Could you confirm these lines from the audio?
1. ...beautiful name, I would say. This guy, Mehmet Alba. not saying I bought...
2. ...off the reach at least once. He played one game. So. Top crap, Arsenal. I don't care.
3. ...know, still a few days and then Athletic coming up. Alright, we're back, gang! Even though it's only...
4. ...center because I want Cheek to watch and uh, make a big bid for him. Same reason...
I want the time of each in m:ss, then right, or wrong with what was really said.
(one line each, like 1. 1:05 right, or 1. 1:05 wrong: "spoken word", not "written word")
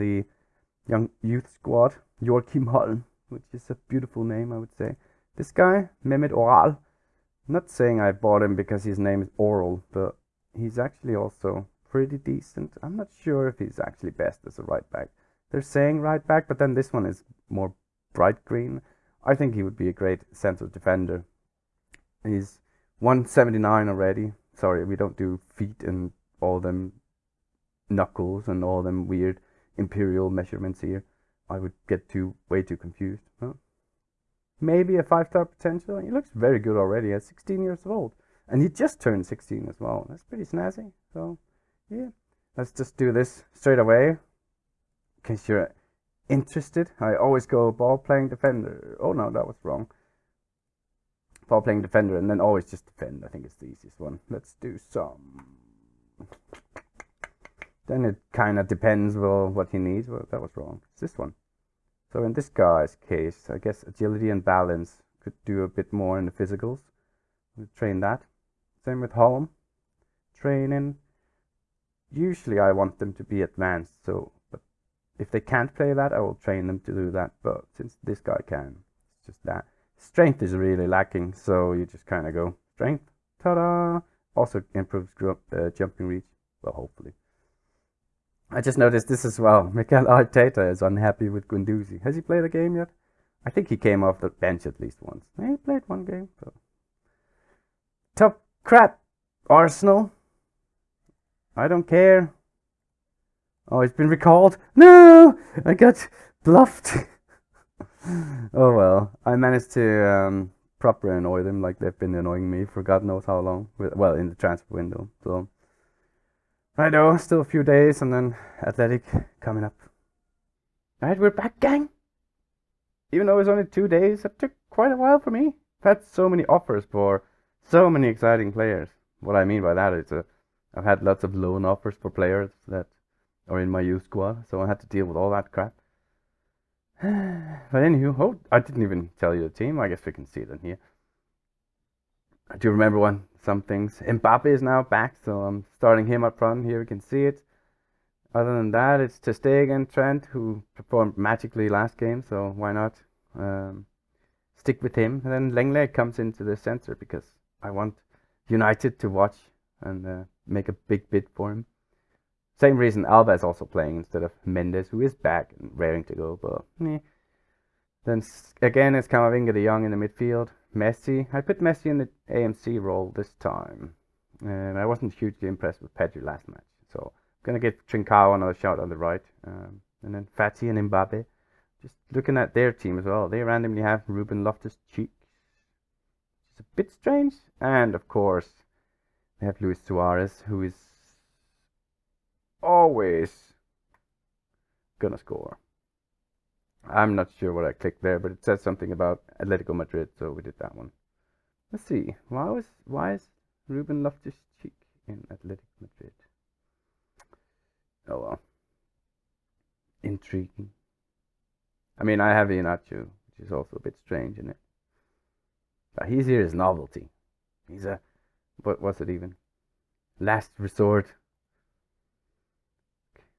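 1. 0:03 wrong: "Oral", not "Alba"
2. 1:34 wrong: "bench", not "reach"
3. 1:56 right
4. 2:36 wrong: "United", not "Cheek".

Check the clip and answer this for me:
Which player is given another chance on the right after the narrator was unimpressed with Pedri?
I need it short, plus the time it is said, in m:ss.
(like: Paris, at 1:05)
Trincao, at 2:57.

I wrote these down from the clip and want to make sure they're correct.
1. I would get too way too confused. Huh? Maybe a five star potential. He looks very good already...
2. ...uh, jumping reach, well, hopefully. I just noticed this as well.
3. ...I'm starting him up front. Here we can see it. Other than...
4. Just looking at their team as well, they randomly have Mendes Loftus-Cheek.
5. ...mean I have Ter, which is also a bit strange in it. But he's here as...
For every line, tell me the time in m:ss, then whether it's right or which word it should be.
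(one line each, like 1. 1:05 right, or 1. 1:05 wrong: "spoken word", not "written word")
1. 0:31 right
2. 1:25 right
3. 2:25 right
4. 3:01 wrong: "Ruben", not "Mendes"
5. 3:32 wrong: "Ianacho", not "Ter".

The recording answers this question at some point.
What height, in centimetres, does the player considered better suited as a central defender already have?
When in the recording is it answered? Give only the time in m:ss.
0:22.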